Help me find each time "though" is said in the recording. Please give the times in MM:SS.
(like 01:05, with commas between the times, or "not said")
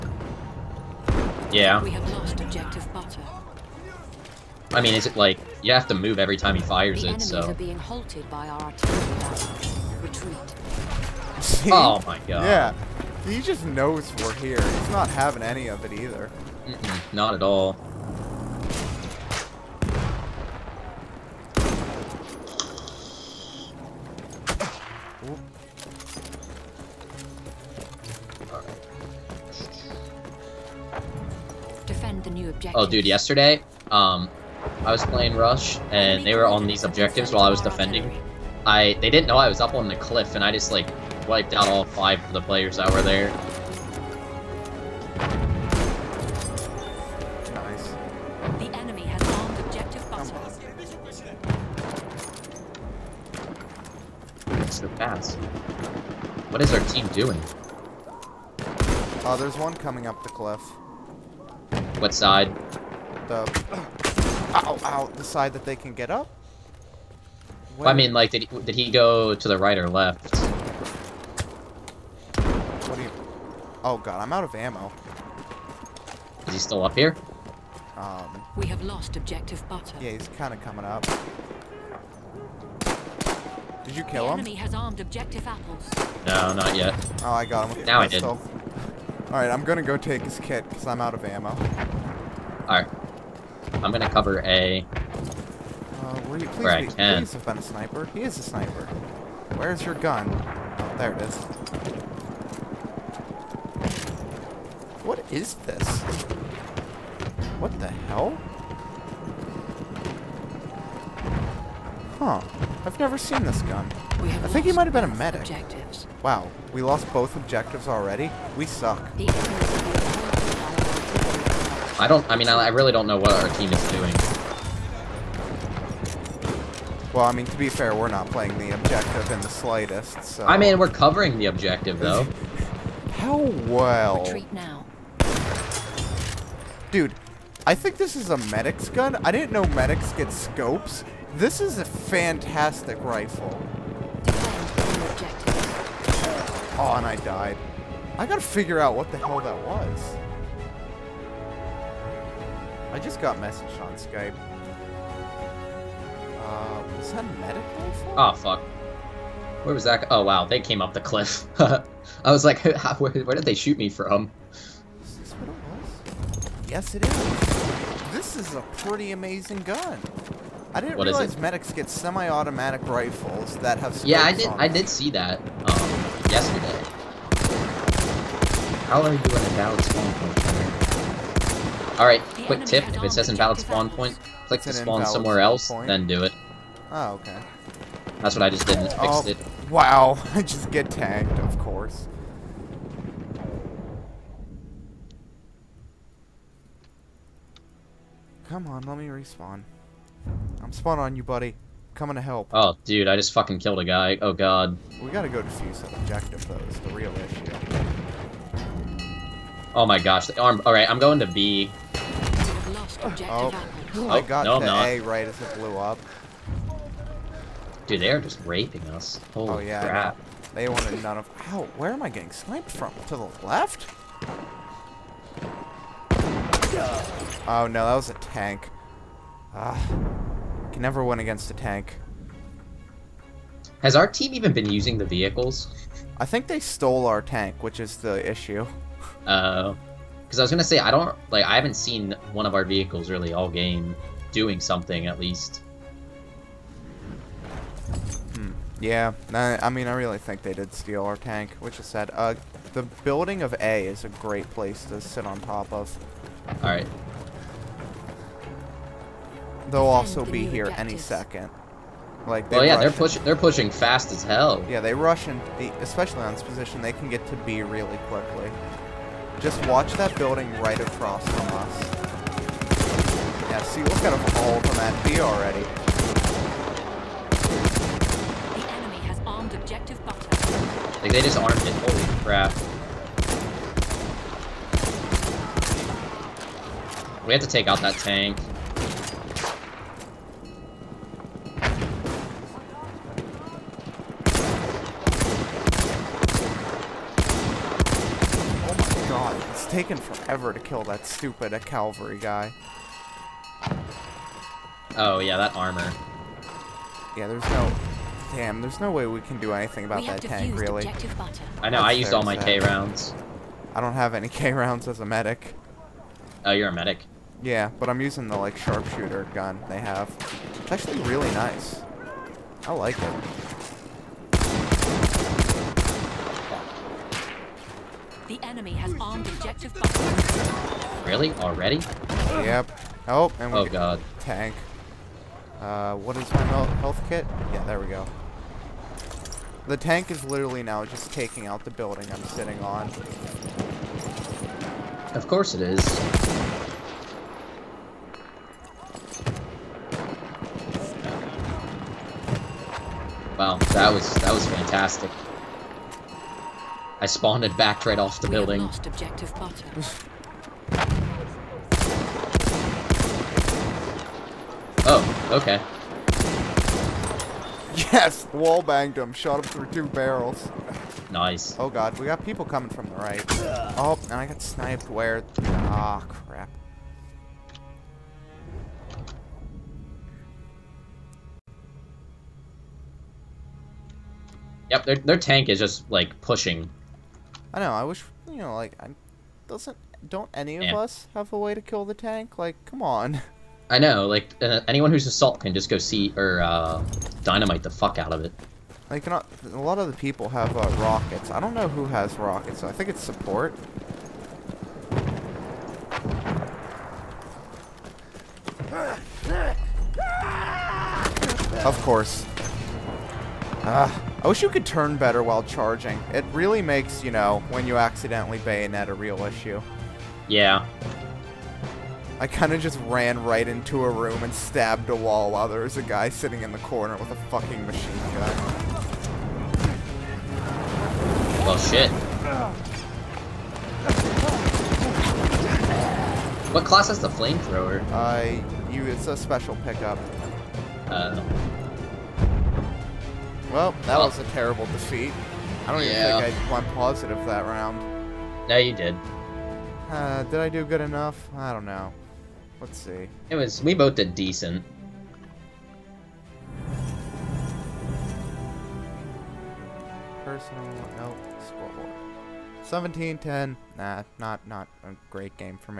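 02:12, 03:26.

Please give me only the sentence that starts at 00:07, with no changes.
Are being halted by our Retreat.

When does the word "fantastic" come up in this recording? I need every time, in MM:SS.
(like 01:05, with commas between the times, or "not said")
02:21, 05:54.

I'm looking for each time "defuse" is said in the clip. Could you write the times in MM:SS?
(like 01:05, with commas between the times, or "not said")
03:25.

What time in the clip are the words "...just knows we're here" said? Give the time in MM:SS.
00:13.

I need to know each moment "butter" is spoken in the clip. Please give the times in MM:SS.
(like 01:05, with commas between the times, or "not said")
00:02, 01:19, 04:40.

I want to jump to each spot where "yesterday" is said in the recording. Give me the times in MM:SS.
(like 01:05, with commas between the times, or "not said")
00:33, 02:56.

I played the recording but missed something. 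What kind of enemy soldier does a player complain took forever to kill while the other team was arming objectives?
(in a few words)
cavalry.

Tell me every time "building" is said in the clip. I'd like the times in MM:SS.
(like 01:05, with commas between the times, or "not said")
04:13, 04:30, 05:41, 05:58.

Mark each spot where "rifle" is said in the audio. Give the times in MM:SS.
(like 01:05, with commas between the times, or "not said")
02:23, 02:52.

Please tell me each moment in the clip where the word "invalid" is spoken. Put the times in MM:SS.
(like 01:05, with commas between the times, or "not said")
03:03.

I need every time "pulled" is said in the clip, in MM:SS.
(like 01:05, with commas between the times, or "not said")
not said.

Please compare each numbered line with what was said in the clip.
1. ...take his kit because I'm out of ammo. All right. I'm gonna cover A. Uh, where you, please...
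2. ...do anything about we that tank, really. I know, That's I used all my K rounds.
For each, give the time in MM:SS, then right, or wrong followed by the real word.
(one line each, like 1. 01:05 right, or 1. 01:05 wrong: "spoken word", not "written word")
1. 01:29 right
2. 05:09 right.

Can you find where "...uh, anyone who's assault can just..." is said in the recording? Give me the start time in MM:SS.
06:34.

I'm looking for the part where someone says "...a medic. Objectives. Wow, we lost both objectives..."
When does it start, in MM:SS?
01:55.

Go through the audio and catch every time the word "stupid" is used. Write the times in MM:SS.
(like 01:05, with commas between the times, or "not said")
05:01.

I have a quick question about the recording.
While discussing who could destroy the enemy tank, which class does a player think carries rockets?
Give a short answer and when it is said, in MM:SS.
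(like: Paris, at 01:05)
support, at 06:43.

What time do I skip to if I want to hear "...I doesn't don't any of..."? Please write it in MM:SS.
06:28.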